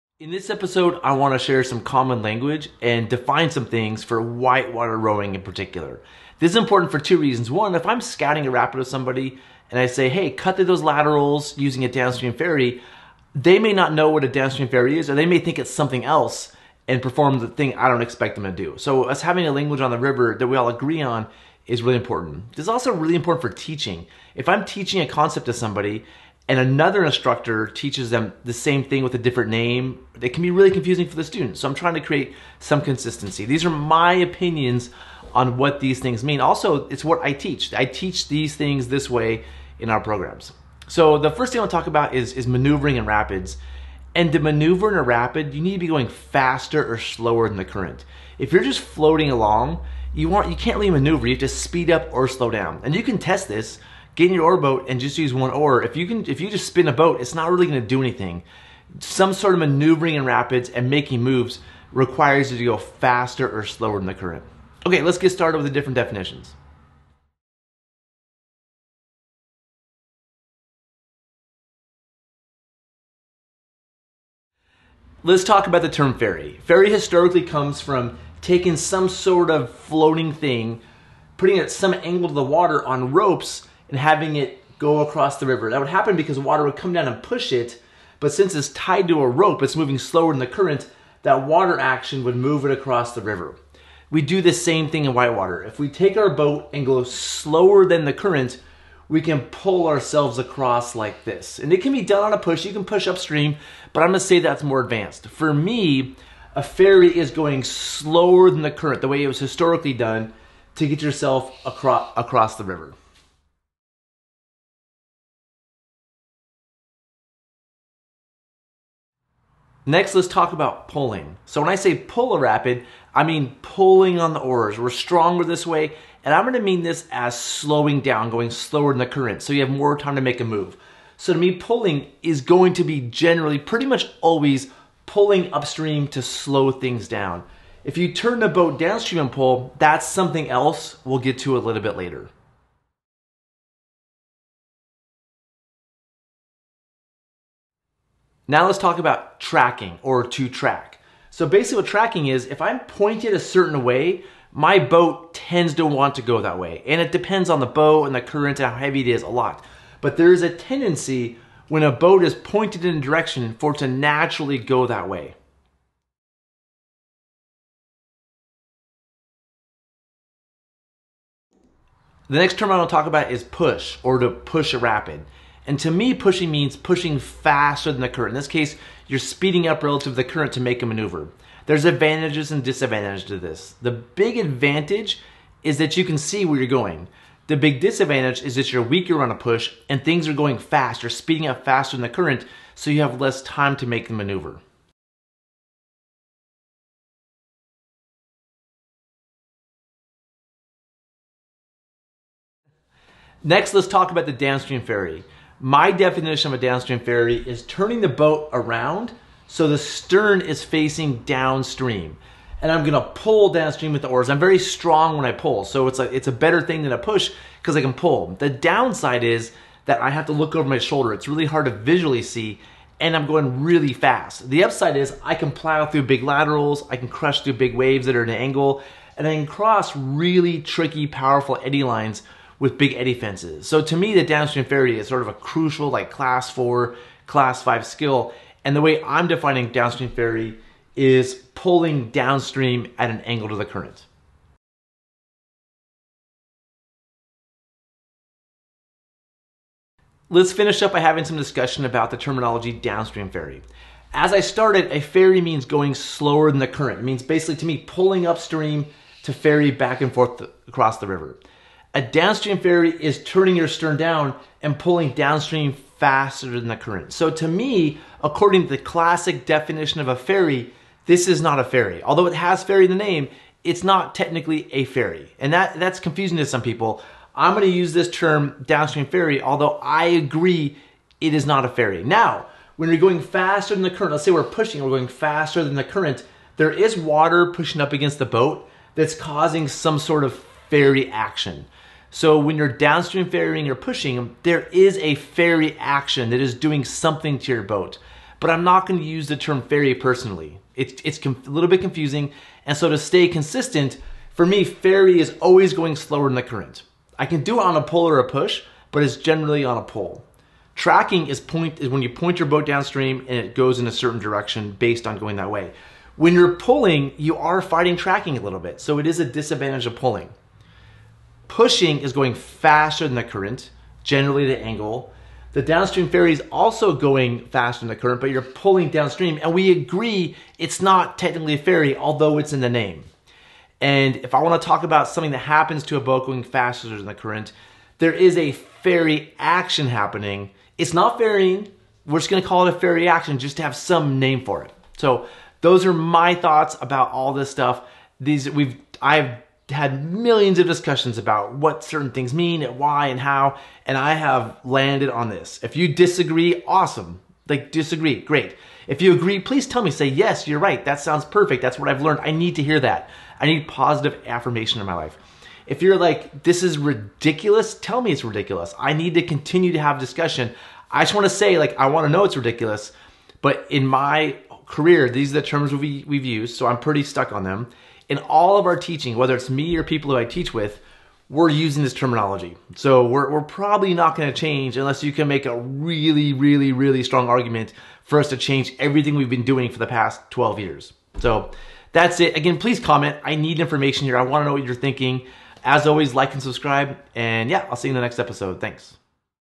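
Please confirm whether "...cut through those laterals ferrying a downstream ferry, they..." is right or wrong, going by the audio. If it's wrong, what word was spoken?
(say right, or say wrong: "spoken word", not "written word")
wrong: "using", not "ferrying".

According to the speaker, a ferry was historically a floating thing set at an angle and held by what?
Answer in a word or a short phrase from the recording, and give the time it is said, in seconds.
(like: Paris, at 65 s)
ropes, at 83 s.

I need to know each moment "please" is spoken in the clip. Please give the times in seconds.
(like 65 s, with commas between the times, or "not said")
359 s, 392 s.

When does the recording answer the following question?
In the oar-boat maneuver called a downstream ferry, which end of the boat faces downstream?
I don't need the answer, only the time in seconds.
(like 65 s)
209 s.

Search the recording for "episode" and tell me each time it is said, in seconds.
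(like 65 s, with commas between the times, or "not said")
0 s, 398 s.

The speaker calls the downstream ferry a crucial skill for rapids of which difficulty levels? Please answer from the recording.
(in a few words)
class four, class five.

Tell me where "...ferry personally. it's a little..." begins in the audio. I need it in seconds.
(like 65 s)
299 s.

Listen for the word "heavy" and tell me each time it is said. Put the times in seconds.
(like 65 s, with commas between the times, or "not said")
158 s.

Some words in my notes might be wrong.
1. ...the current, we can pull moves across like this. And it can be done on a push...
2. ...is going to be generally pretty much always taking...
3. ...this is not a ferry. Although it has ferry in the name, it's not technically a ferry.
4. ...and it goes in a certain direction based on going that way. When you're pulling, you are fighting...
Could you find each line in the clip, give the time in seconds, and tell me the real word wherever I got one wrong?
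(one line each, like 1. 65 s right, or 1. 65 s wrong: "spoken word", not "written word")
1. 98 s wrong: "ourselves", not "moves"
2. 132 s wrong: "pulling", not "taking"
3. 271 s right
4. 313 s right.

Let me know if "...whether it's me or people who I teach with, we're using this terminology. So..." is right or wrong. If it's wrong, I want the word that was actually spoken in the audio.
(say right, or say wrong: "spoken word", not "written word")
right.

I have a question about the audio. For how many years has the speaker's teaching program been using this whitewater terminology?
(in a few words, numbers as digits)
12.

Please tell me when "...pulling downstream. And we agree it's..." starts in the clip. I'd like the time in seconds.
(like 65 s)
328 s.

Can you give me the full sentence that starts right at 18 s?
So us having a language on the river that we all agree on is really important.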